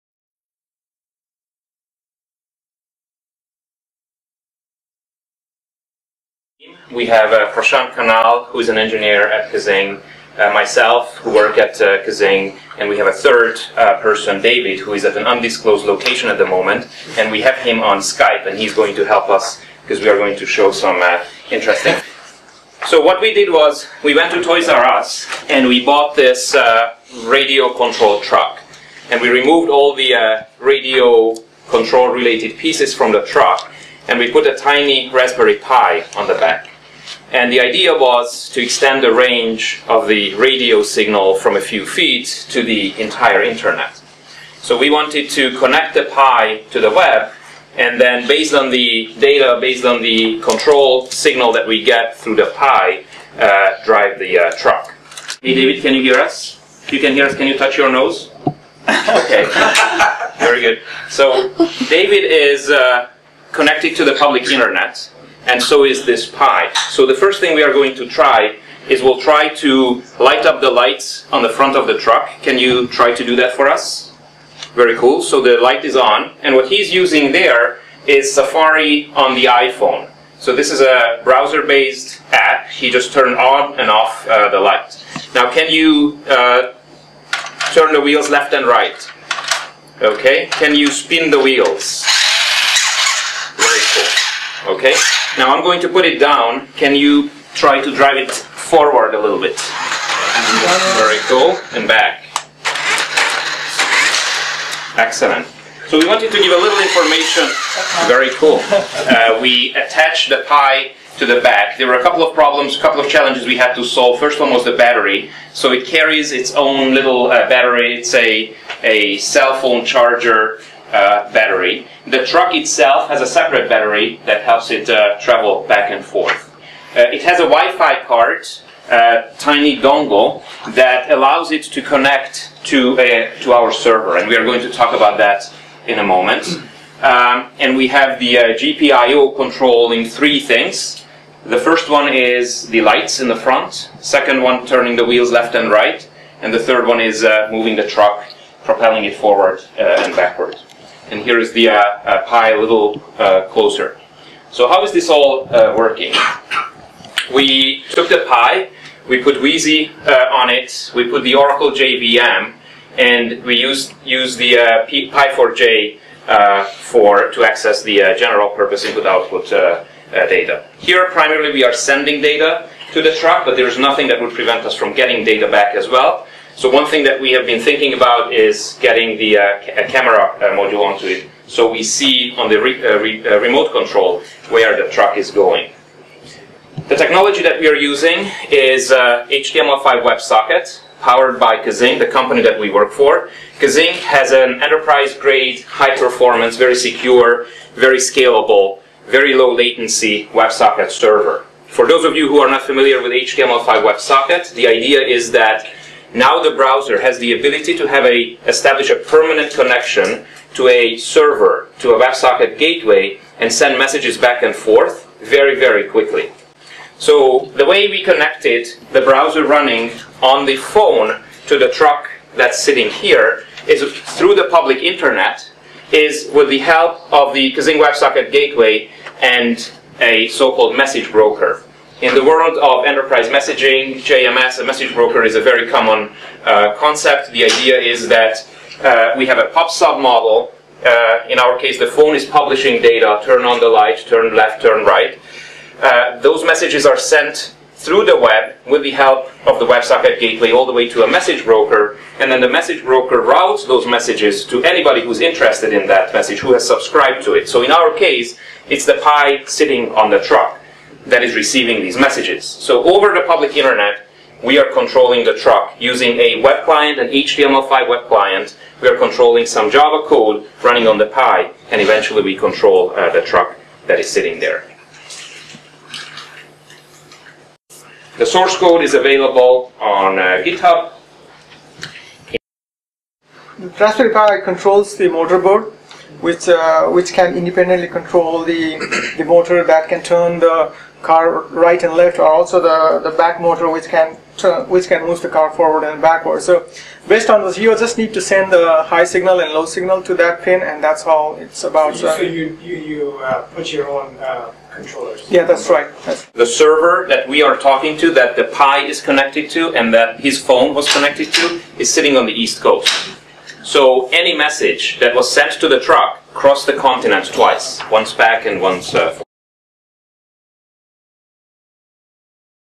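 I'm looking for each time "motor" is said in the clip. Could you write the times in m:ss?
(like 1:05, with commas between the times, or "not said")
4:49, 4:53.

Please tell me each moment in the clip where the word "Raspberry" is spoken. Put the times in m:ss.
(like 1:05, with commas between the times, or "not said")
0:35, 4:43.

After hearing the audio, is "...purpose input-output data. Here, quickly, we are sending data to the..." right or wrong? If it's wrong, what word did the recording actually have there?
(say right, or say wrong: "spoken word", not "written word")
wrong: "primarily", not "quickly".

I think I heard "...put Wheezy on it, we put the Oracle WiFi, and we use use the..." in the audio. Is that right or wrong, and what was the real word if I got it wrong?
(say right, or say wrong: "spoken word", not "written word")
wrong: "JVM", not "WiFi".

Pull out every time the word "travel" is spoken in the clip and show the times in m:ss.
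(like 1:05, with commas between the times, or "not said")
2:05.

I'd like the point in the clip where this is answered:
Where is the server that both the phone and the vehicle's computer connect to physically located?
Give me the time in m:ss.
5:12.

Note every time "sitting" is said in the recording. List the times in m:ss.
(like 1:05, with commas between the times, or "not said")
3:42, 4:19, 4:34, 5:11.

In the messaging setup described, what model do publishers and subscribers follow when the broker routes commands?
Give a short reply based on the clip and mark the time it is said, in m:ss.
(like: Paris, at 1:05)
Pub-sub, at 3:59.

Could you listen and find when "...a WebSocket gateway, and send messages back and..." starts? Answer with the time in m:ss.
3:31.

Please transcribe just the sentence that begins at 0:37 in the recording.
And the idea was to extend the range of the radio signal from a few feet to the entire internet.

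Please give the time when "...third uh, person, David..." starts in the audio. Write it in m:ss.
0:13.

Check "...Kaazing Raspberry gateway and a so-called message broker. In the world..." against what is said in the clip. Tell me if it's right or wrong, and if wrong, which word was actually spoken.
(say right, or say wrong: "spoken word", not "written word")
wrong: "WebSocket", not "Raspberry".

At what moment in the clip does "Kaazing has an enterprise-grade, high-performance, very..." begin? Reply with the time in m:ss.
3:13.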